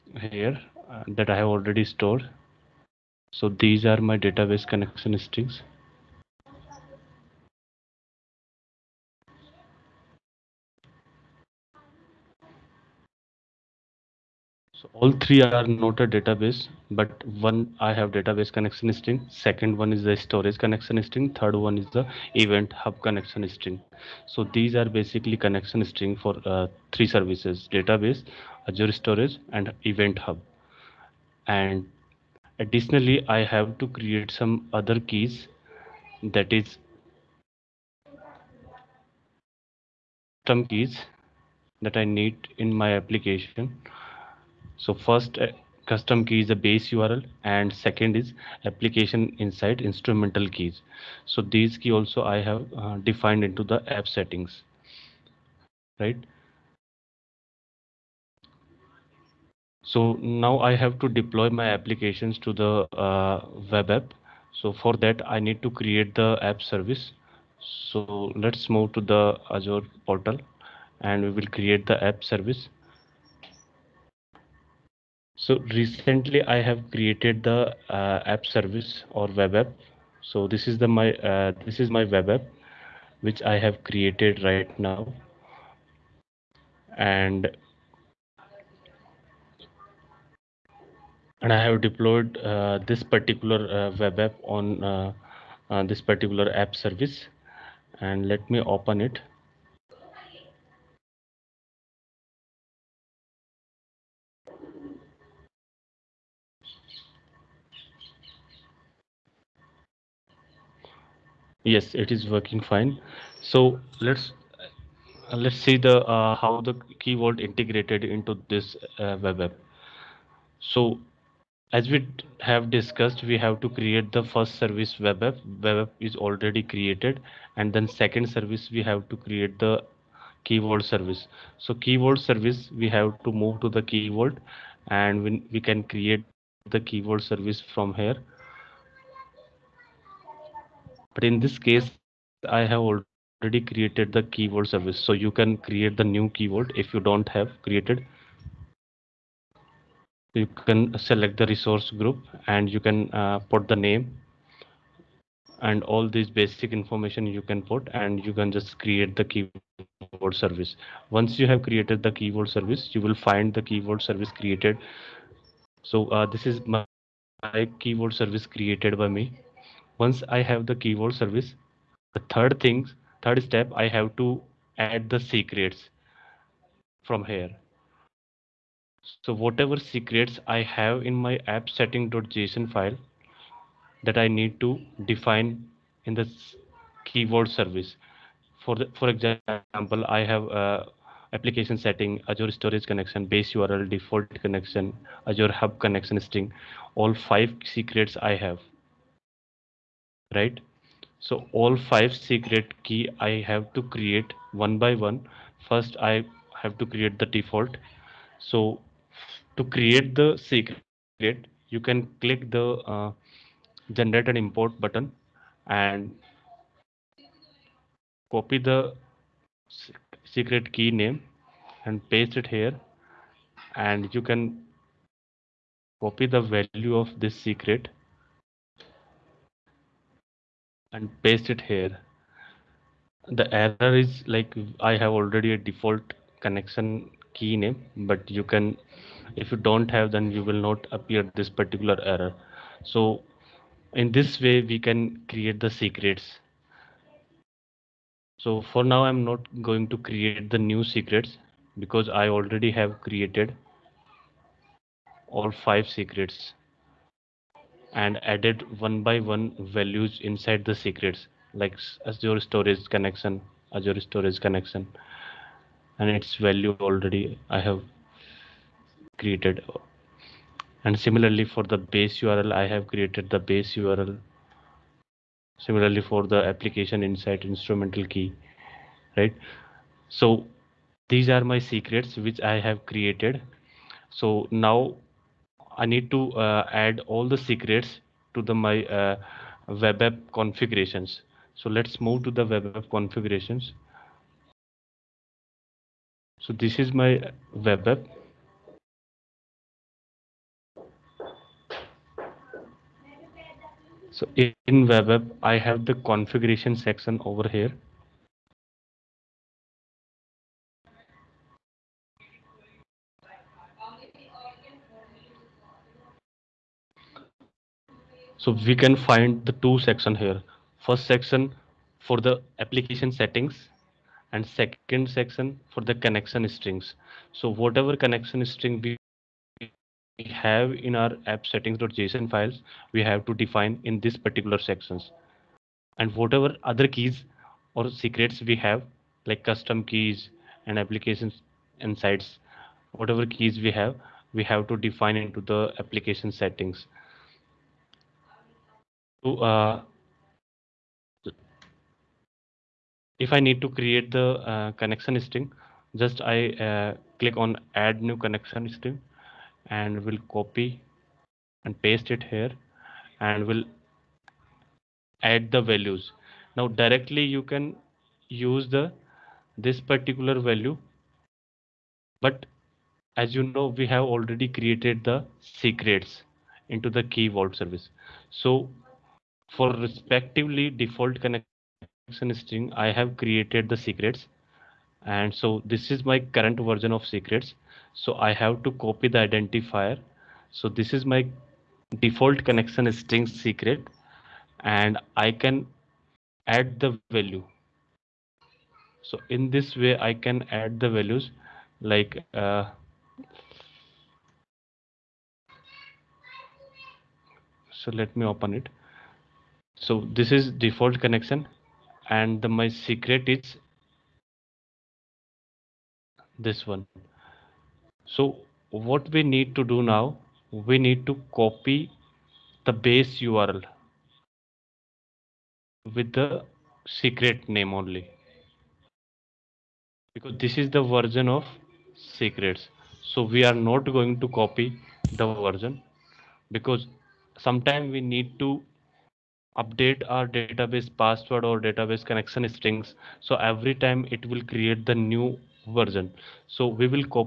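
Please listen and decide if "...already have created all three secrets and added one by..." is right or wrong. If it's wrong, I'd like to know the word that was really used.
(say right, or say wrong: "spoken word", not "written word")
wrong: "five", not "three".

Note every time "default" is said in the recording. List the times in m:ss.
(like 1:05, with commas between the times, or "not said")
3:13, 3:27, 3:55, 6:20, 6:32, 6:50.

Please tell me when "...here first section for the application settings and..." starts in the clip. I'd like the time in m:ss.
5:20.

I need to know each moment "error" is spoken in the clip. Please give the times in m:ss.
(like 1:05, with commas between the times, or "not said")
3:53, 4:02.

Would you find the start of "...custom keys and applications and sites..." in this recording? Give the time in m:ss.
5:39.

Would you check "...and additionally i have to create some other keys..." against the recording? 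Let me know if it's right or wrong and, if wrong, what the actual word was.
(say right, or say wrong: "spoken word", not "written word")
right.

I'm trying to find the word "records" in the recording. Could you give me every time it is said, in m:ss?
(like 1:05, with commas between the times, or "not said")
not said.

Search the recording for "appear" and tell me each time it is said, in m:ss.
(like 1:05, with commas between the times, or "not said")
4:00.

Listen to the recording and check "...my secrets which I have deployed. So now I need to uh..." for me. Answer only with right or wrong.
wrong.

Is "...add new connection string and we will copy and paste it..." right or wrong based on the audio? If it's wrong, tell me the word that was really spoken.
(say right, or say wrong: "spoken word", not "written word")
right.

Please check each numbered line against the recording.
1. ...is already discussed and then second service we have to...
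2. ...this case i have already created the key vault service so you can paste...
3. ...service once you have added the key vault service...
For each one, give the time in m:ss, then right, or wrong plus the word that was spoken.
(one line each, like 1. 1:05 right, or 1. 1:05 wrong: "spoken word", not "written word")
1. 2:06 wrong: "created", not "discussed"
2. 2:21 wrong: "create", not "paste"
3. 2:40 wrong: "created", not "added".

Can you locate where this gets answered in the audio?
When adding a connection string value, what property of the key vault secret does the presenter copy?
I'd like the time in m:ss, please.
6:29.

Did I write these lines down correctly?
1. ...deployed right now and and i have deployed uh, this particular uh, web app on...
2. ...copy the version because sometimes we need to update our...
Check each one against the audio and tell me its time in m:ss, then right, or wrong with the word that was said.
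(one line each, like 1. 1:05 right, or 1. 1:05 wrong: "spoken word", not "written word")
1. 1:23 wrong: "created", not "deployed"
2. 7:14 right.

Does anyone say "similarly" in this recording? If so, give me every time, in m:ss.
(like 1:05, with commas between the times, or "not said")
4:30, 4:35.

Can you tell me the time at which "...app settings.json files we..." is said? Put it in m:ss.
5:31.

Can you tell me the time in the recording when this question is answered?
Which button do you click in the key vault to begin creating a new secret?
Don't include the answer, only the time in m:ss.
3:33.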